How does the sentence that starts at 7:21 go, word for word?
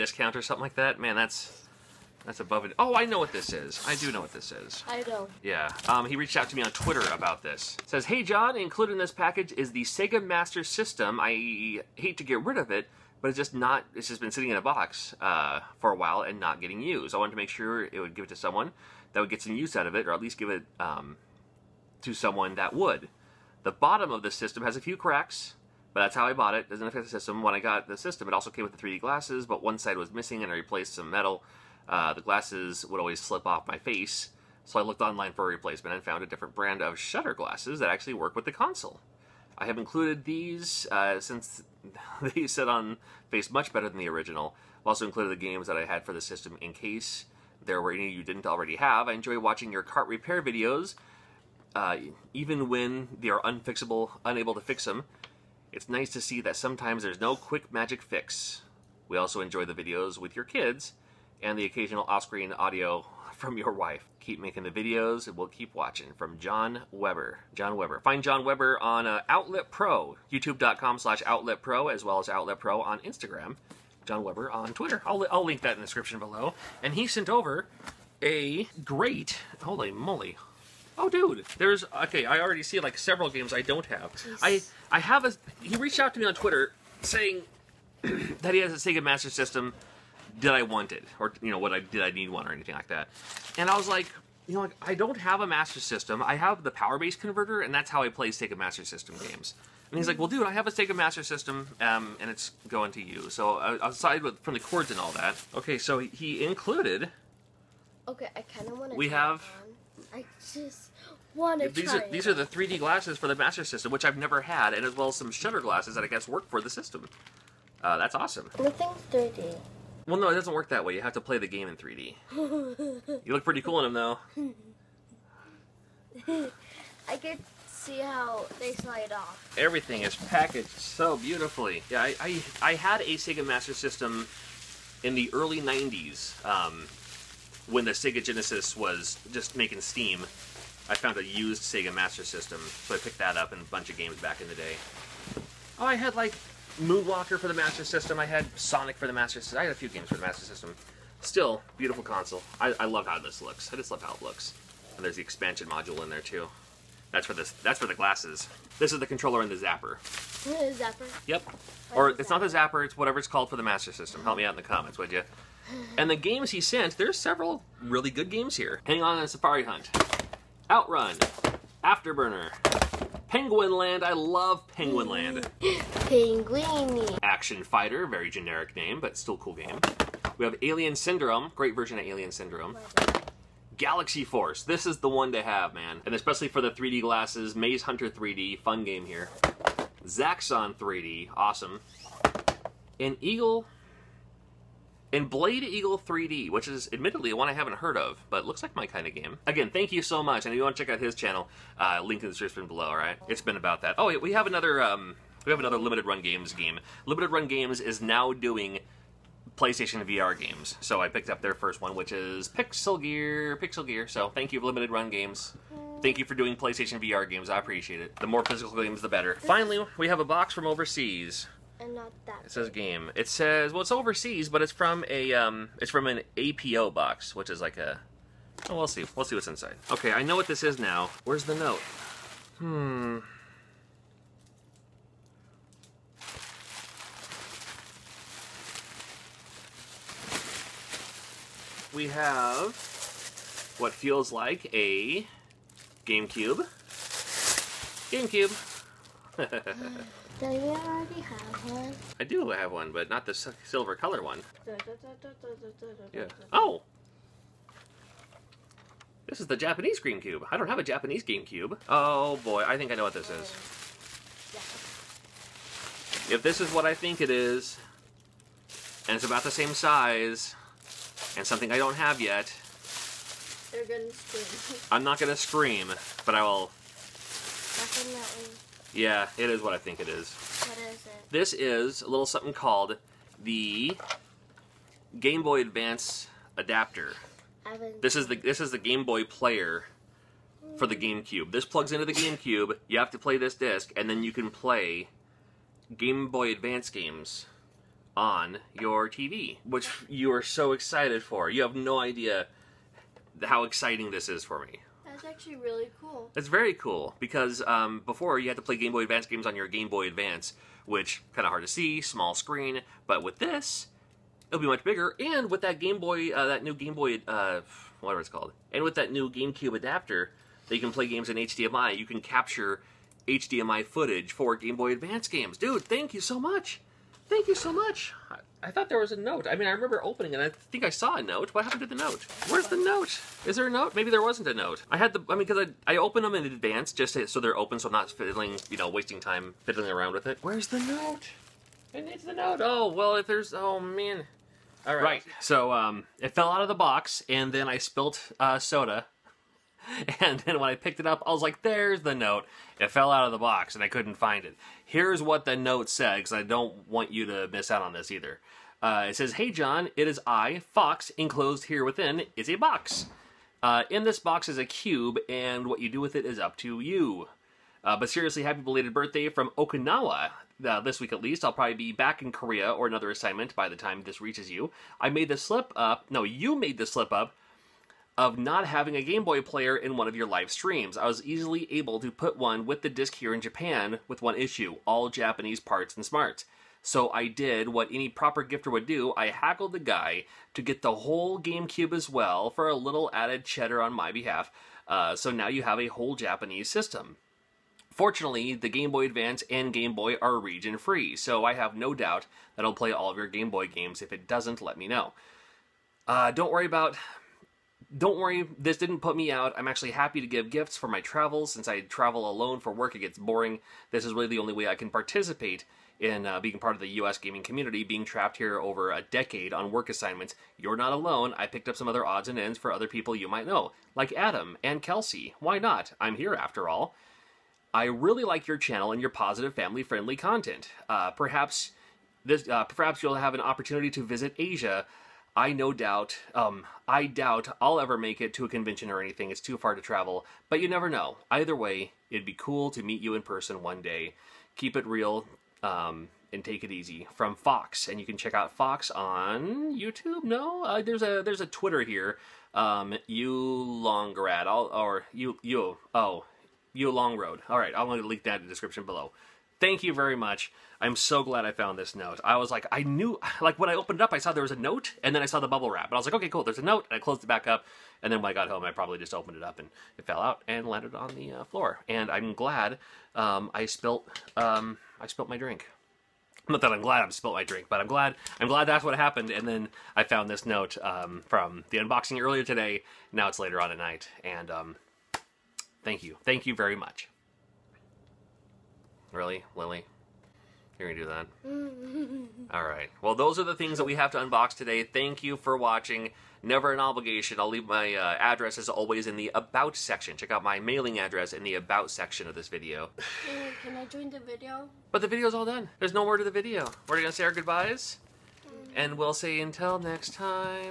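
Either way, it'd be cool to meet you in person one day.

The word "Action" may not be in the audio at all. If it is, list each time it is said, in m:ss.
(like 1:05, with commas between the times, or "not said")
2:57.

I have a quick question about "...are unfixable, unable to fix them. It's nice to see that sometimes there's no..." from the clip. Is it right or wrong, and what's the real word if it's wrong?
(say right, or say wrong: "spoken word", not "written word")
right.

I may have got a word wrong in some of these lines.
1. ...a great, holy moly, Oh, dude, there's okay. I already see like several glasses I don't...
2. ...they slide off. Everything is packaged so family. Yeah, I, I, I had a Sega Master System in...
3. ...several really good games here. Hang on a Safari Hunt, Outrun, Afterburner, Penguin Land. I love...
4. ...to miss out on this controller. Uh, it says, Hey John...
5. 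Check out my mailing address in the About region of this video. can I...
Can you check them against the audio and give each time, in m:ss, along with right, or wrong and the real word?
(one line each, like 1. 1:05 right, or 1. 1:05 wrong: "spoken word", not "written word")
1. 1:18 wrong: "games", not "glasses"
2. 2:08 wrong: "beautifully", not "family"
3. 2:47 right
4. 5:57 wrong: "either", not "controller"
5. 8:20 wrong: "section", not "region".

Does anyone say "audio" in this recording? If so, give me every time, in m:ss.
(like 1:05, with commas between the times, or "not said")
1:02.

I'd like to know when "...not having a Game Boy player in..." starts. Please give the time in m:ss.
6:18.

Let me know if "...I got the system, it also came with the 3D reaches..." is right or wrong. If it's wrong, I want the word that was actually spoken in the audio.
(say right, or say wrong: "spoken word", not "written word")
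wrong: "glasses", not "reaches".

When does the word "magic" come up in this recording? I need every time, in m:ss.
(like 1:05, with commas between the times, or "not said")
0:57.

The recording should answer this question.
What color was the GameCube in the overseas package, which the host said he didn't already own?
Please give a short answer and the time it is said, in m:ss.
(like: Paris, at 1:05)
Silver, at 4:13.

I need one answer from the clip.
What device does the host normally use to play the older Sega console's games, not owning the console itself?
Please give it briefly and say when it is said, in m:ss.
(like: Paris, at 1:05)
Power Base Converter, at 1:36.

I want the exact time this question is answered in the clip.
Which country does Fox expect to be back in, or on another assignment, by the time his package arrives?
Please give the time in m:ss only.
6:12.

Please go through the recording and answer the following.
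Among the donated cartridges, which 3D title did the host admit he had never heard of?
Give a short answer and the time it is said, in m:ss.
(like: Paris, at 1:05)
Blade Eagle 3D, at 3:15.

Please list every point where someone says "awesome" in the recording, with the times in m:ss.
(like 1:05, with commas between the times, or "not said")
1:58, 3:11.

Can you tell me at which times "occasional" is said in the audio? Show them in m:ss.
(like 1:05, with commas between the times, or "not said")
1:01.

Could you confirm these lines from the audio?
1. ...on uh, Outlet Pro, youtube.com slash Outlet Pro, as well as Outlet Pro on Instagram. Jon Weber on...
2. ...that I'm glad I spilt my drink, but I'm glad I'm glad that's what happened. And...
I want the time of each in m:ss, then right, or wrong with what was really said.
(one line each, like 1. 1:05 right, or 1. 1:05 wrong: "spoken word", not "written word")
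1. 1:08 right
2. 7:56 right.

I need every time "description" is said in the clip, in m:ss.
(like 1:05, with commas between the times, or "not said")
1:15, 3:22, 7:38.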